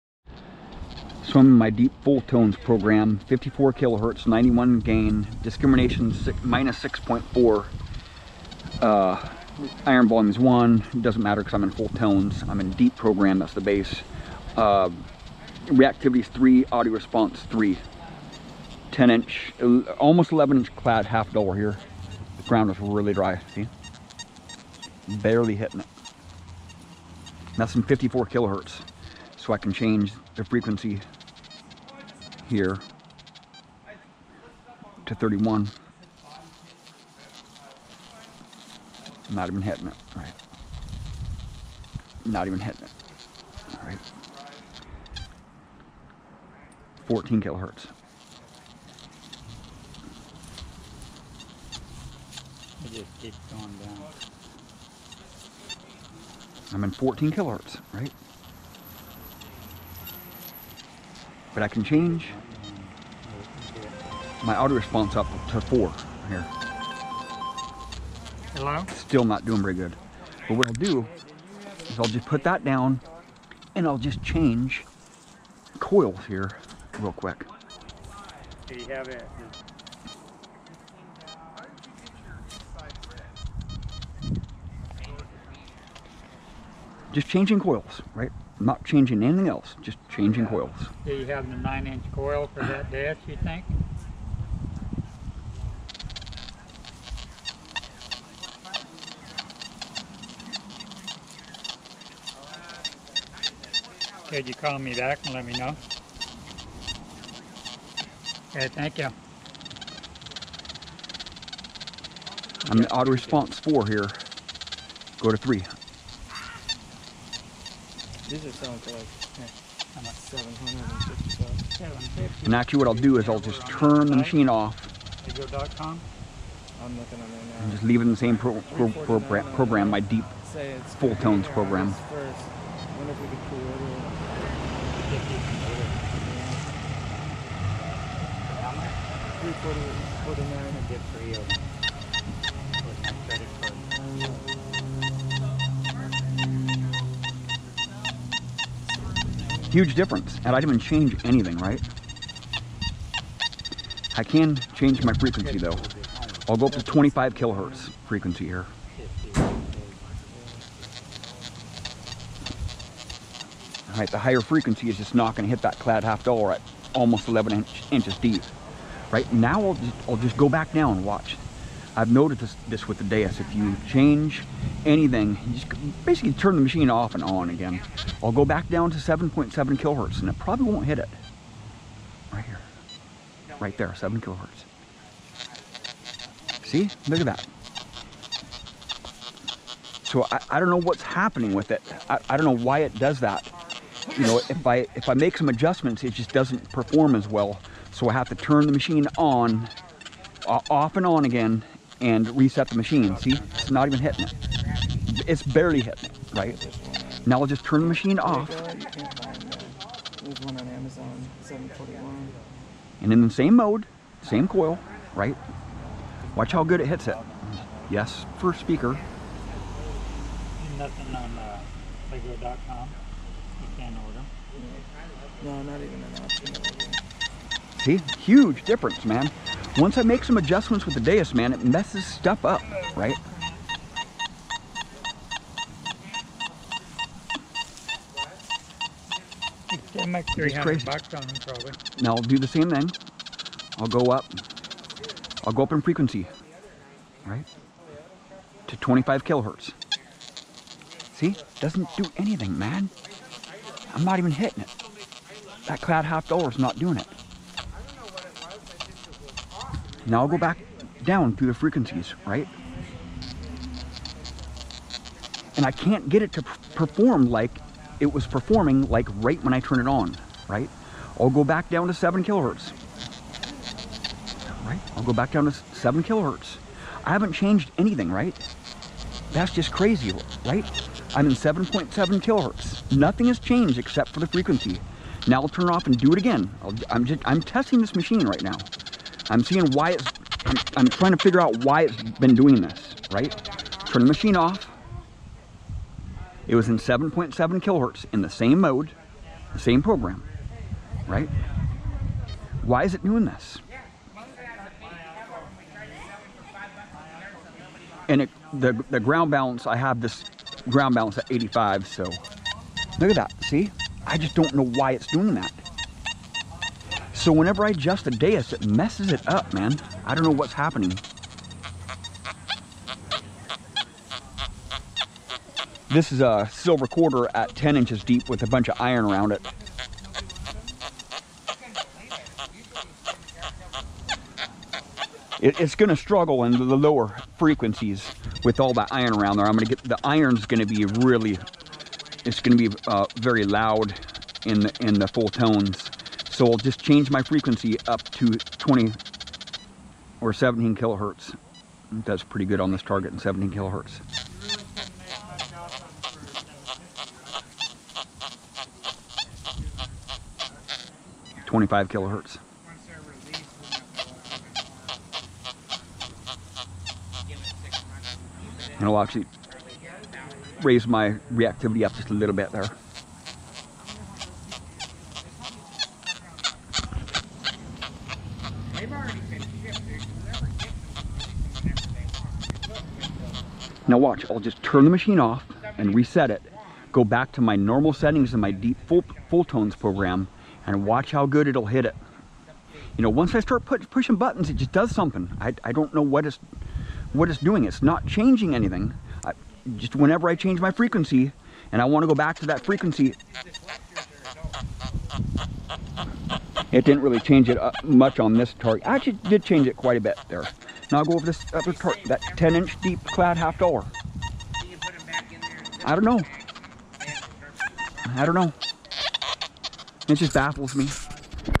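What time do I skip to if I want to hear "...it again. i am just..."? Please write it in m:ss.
4:46.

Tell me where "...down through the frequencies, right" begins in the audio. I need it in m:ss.
4:21.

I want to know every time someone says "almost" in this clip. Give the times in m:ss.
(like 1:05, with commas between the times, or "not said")
0:19, 2:46.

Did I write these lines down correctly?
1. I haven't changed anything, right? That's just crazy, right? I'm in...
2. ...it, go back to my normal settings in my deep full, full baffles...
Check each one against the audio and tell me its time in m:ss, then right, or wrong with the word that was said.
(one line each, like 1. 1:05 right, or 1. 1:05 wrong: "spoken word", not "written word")
1. 4:37 right
2. 6:26 wrong: "tones", not "baffles".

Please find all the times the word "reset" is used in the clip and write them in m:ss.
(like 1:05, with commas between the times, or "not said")
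3:22, 6:25.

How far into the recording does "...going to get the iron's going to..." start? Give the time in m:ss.
5:39.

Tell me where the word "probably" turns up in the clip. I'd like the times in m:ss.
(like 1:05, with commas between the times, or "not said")
3:00.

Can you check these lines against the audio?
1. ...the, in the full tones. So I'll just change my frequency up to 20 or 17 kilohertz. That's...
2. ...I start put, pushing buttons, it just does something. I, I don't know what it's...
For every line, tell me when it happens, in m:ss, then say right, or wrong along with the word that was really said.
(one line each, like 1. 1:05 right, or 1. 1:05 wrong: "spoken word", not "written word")
1. 5:44 right
2. 6:33 right.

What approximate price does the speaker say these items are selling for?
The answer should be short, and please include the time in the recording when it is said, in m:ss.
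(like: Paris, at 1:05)
750, at 2:00.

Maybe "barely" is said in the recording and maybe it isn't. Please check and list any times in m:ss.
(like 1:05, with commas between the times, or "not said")
0:25, 3:25.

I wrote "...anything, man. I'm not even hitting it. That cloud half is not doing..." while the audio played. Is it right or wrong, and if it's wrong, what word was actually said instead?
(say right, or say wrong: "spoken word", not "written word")
right.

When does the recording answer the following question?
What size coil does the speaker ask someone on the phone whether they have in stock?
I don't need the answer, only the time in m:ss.
1:31.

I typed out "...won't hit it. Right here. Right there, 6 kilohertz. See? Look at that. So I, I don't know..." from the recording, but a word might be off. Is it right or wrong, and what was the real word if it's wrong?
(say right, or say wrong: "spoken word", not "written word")
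wrong: "7", not "6".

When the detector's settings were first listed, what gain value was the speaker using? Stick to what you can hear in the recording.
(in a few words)
91.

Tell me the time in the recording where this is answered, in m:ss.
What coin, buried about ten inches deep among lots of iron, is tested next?
5:26.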